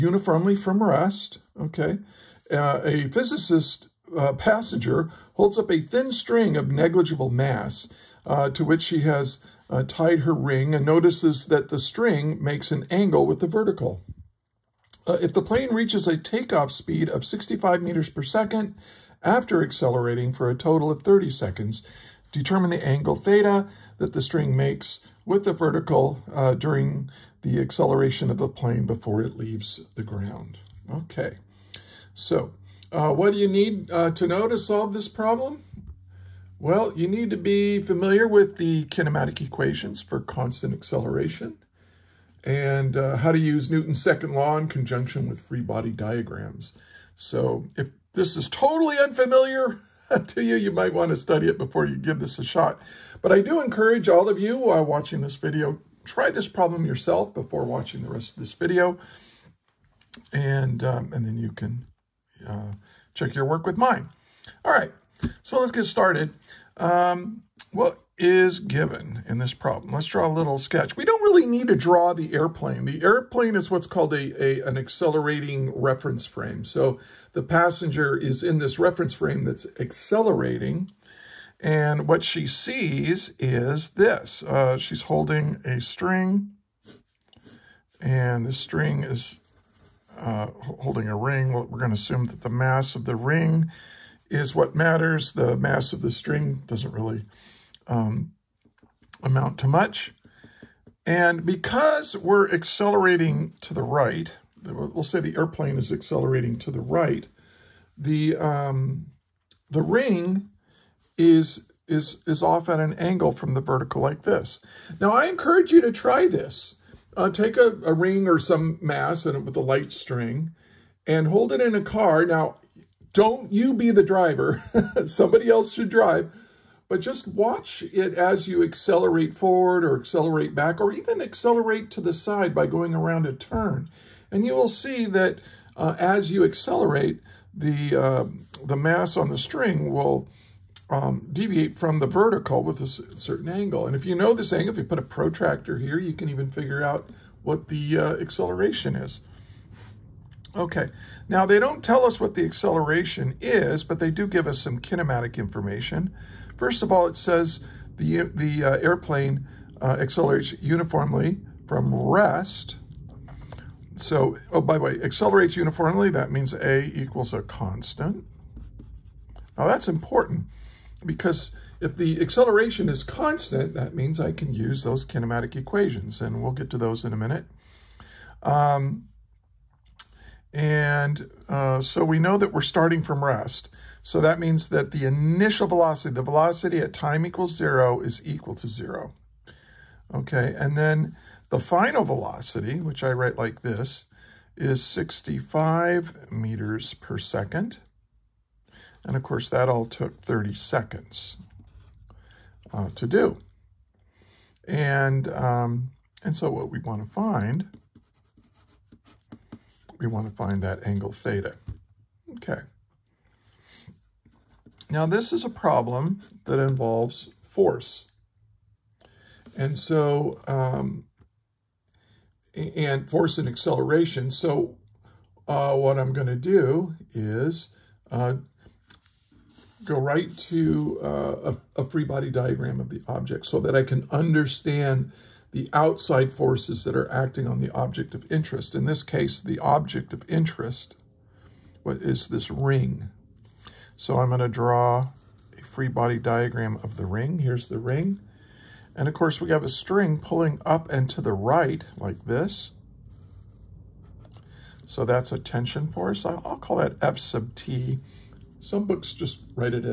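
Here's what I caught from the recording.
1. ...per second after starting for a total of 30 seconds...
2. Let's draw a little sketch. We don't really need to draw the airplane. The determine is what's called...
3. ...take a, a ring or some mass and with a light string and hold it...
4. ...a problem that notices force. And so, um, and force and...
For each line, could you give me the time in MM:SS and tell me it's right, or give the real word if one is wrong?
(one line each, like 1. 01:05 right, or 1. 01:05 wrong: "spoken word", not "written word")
1. 00:18 wrong: "accelerating", not "starting"
2. 01:09 wrong: "airplane", not "determine"
3. 01:57 right
4. 03:35 wrong: "involves", not "notices".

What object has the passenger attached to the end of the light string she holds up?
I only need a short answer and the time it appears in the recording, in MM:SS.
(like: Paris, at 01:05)
her ring, at 00:10.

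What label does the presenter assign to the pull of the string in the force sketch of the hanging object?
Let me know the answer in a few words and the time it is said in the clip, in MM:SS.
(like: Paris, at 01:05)
F sub T, at 04:17.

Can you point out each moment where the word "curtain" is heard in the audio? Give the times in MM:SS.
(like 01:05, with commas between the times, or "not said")
not said.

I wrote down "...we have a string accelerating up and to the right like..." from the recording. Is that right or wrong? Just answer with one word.
wrong.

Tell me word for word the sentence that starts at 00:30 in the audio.
Okay, so uh, what do you need uh, to know to solve this problem?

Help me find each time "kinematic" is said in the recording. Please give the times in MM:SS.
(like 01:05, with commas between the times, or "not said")
00:38, 02:34, 02:55.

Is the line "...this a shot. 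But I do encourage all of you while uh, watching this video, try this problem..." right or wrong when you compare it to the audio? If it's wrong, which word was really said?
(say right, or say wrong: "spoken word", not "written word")
right.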